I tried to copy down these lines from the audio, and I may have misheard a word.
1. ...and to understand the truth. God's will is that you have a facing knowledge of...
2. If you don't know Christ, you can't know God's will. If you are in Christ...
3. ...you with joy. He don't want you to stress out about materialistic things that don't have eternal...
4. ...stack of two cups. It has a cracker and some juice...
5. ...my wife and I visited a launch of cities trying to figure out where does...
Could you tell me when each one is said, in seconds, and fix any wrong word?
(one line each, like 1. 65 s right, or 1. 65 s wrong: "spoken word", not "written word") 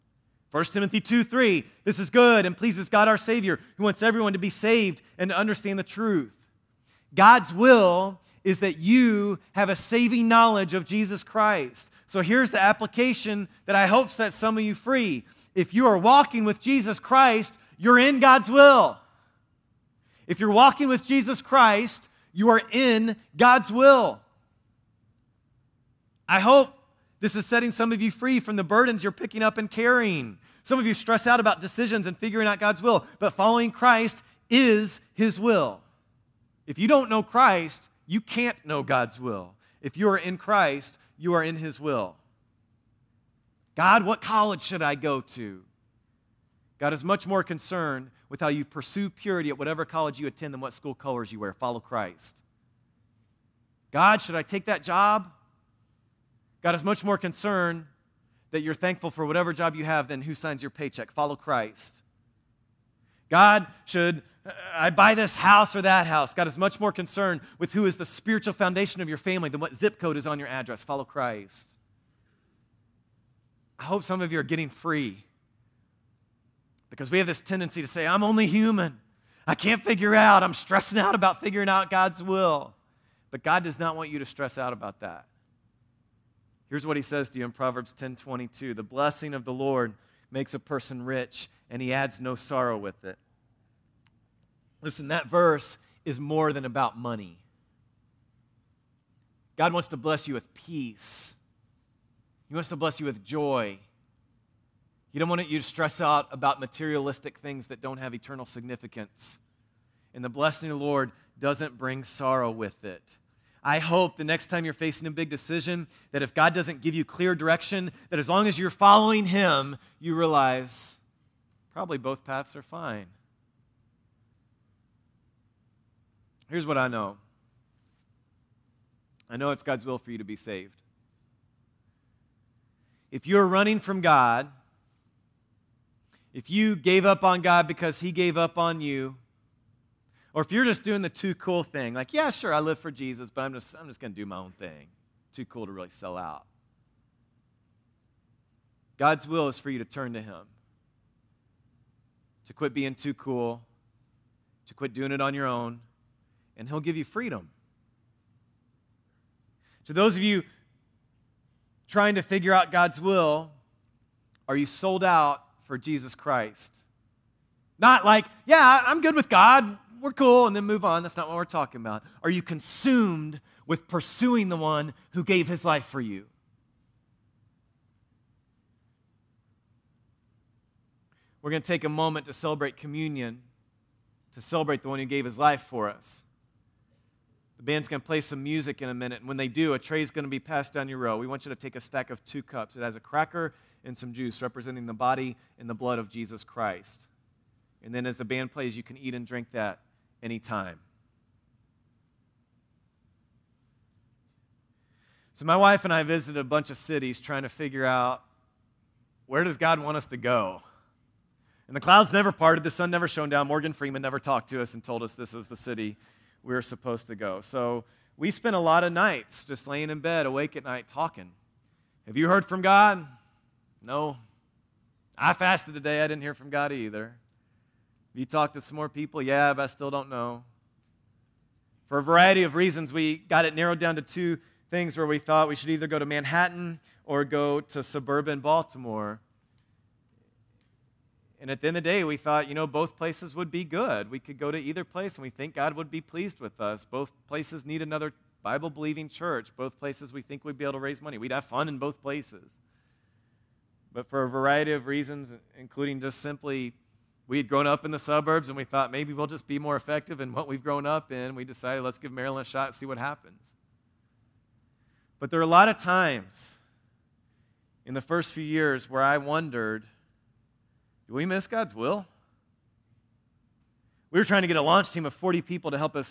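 1. 5 s wrong: "saving", not "facing"
2. 36 s right
3. 102 s right
4. 191 s right
5. 205 s wrong: "bunch", not "launch".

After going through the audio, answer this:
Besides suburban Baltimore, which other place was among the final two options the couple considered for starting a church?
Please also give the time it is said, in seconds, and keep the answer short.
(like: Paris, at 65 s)
Manhattan, at 236 s.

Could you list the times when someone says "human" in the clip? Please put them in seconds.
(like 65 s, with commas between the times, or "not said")
78 s.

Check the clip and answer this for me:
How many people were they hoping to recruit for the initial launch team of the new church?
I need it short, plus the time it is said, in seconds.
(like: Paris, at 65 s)
40, at 275 s.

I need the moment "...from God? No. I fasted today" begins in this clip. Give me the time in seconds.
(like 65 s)
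222 s.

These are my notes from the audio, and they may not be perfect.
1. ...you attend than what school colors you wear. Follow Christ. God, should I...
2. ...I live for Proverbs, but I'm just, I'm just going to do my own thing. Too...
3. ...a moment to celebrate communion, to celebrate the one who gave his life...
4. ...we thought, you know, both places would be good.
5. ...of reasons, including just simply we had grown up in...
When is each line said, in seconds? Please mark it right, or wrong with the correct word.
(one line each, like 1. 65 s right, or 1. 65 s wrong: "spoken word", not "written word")
1. 50 s right
2. 142 s wrong: "Jesus", not "Proverbs"
3. 181 s right
4. 242 s right
5. 254 s right.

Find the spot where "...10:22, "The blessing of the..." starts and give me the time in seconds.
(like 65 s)
87 s.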